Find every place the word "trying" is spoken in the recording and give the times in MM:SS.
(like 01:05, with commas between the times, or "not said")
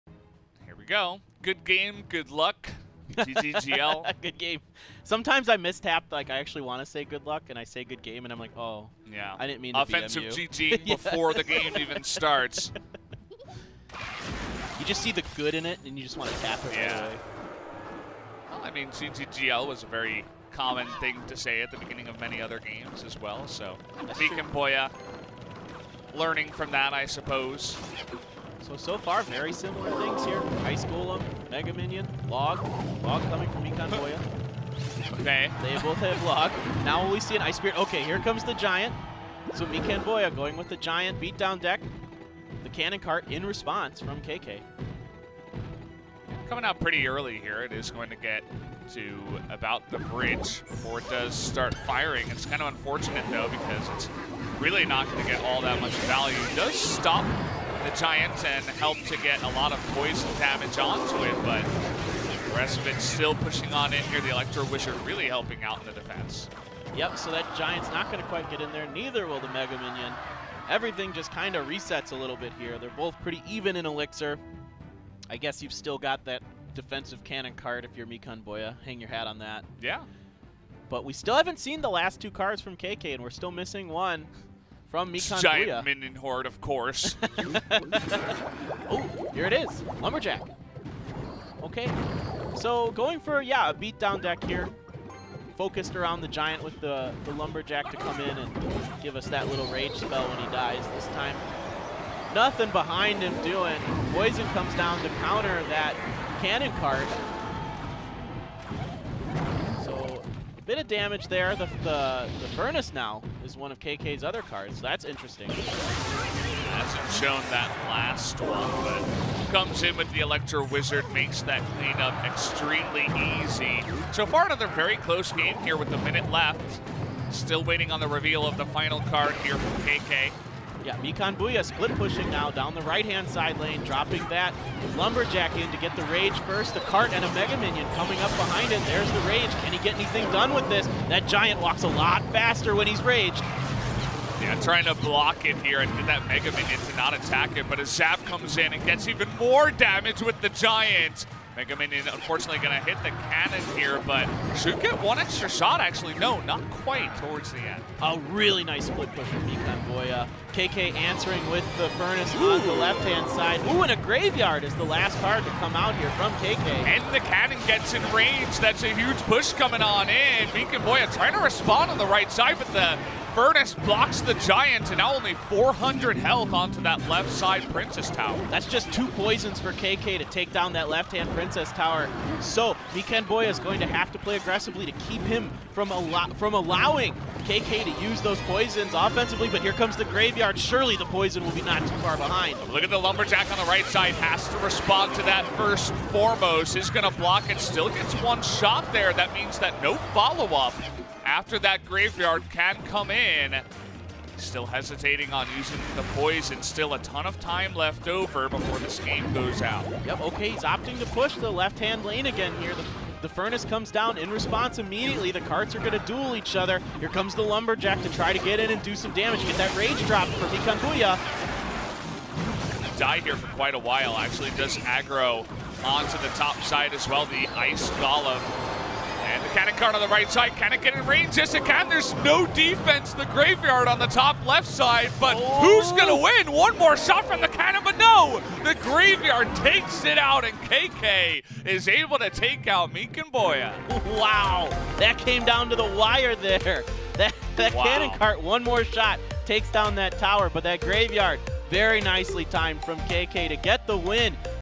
02:24, 02:51.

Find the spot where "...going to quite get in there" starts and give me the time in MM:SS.
01:08.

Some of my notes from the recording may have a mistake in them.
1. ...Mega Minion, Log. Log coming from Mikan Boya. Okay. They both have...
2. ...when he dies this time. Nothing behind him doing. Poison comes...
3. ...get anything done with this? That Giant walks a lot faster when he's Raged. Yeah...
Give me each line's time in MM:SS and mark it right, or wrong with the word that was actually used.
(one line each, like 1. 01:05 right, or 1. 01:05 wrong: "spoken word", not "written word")
1. 00:31 right
2. 01:40 right
3. 02:19 right.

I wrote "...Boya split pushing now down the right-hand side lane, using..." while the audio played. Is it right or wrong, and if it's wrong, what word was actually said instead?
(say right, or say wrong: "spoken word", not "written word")
wrong: "dropping", not "using".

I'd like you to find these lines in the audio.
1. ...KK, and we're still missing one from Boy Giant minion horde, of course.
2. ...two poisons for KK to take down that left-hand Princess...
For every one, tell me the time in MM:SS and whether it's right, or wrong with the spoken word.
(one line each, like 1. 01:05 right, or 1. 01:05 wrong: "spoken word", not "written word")
1. 01:22 wrong: "Mikan", not "Boy"
2. 02:58 right.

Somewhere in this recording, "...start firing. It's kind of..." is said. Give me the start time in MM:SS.
00:51.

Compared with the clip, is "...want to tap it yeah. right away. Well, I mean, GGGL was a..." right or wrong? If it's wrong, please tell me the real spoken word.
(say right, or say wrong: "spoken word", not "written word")
right.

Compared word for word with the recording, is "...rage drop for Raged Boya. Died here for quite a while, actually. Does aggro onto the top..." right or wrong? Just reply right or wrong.
wrong.